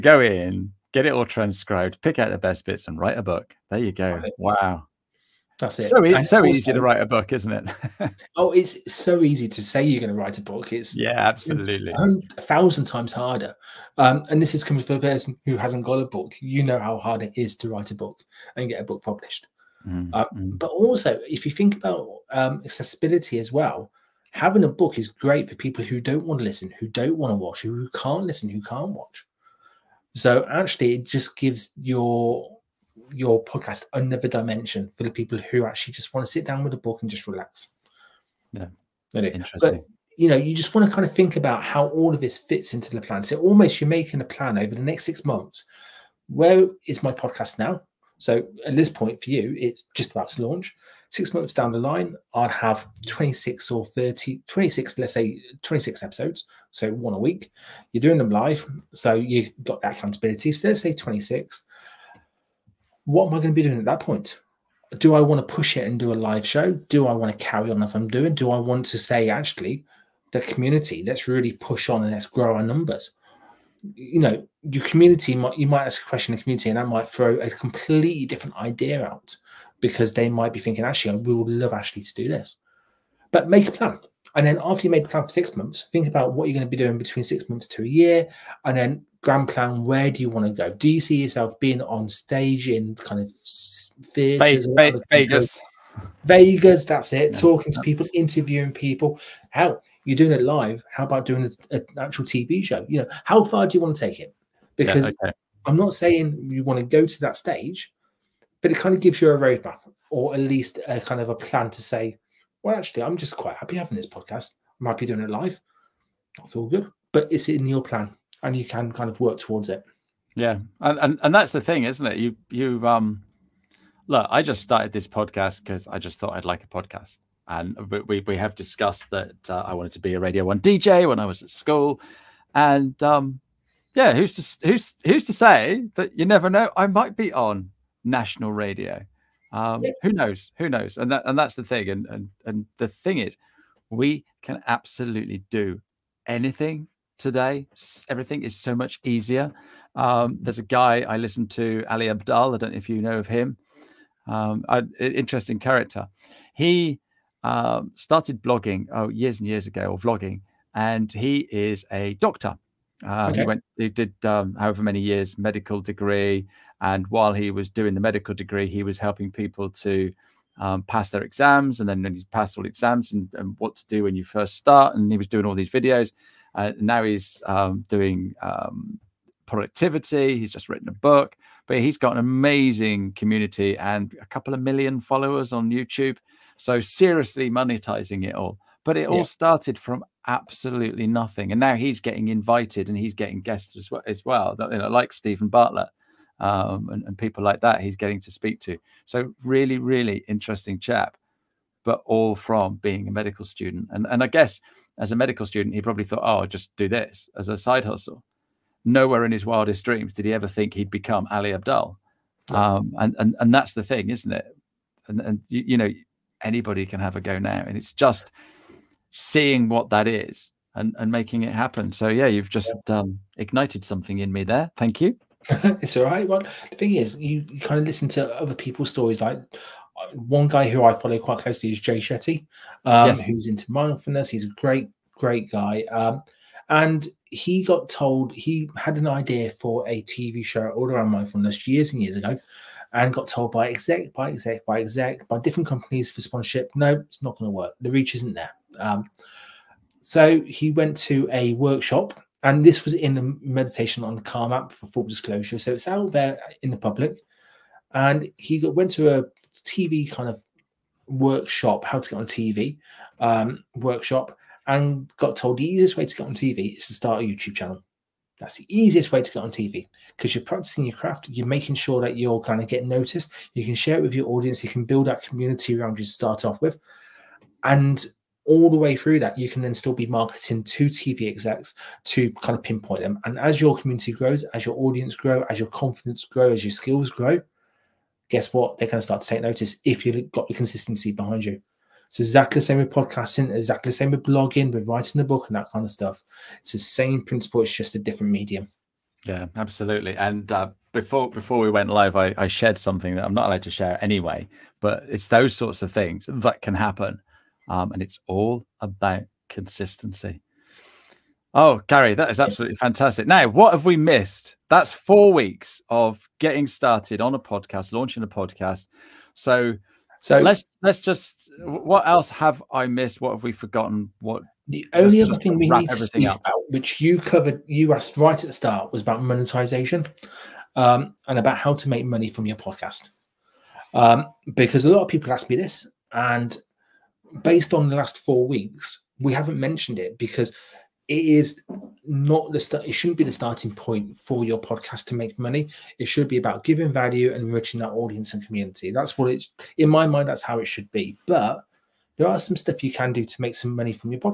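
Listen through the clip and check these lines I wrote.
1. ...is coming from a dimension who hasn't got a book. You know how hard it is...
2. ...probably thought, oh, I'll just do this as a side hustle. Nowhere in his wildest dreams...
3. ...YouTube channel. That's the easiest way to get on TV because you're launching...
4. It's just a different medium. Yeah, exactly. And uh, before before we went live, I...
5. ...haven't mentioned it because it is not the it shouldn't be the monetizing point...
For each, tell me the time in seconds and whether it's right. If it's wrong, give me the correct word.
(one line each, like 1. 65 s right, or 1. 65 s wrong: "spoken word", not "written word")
1. 14 s wrong: "person", not "dimension"
2. 205 s right
3. 267 s wrong: "practicing", not "launching"
4. 297 s wrong: "absolutely", not "exactly"
5. 339 s wrong: "starting", not "monetizing".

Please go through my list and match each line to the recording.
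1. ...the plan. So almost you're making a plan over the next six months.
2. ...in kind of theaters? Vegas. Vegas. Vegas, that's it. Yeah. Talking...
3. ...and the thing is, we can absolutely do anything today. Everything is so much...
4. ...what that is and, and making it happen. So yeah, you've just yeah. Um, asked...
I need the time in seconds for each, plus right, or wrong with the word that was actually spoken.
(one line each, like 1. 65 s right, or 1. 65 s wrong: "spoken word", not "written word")
1. 42 s right
2. 92 s right
3. 142 s right
4. 219 s wrong: "ignited", not "asked".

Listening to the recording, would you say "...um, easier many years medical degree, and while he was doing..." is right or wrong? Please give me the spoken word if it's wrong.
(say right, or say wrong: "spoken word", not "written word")
wrong: "however", not "easier".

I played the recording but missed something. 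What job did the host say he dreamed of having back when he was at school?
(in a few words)
Radio 1 DJ.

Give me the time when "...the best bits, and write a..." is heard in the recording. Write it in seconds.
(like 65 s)
2 s.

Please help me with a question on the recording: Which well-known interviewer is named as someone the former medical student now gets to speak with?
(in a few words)
Steven Bartlett.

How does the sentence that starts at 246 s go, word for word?
No, it's not going to work.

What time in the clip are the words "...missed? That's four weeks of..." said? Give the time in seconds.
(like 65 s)
313 s.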